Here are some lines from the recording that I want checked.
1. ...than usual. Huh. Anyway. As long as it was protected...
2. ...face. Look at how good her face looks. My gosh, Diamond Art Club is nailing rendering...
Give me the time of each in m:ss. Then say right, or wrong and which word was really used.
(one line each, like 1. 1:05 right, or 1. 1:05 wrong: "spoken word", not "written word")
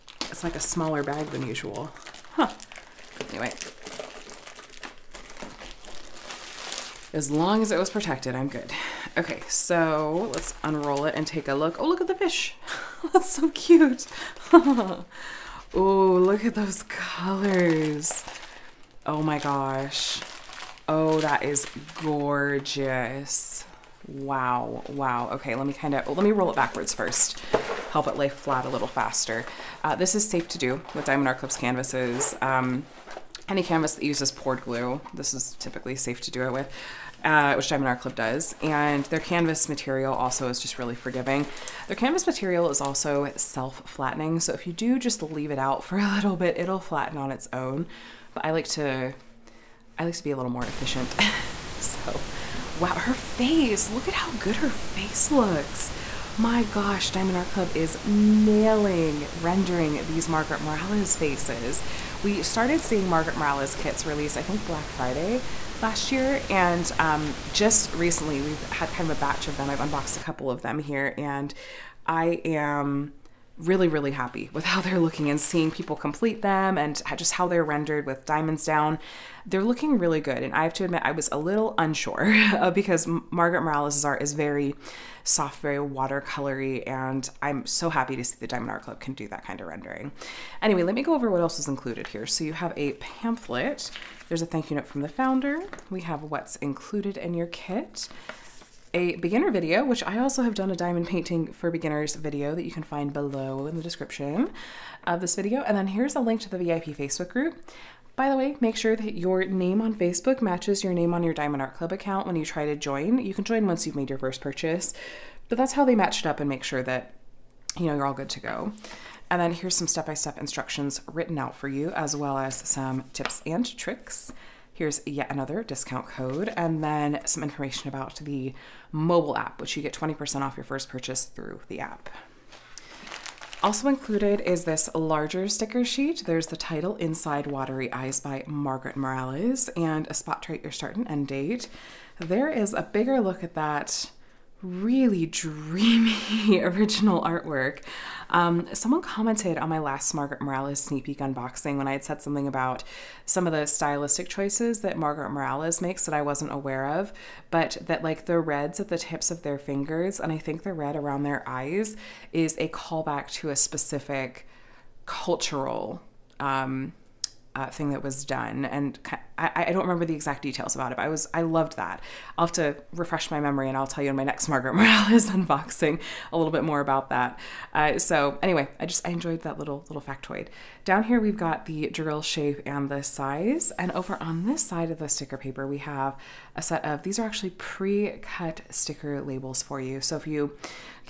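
1. 0:01 right
2. 0:53 right.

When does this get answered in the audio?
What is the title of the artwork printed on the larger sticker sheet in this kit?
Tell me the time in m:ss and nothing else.
2:16.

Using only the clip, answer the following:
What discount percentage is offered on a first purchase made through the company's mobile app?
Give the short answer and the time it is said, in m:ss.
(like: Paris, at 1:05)
20%, at 2:09.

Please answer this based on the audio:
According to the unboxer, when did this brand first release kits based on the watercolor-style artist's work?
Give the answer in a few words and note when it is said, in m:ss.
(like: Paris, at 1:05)
Black Friday last year, at 1:04.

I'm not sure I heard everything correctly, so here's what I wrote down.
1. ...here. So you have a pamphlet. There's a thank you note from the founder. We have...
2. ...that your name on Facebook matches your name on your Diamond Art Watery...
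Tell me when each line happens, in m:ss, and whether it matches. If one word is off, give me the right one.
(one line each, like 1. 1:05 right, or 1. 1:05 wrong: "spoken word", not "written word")
1. 1:32 right
2. 1:48 wrong: "Club", not "Watery".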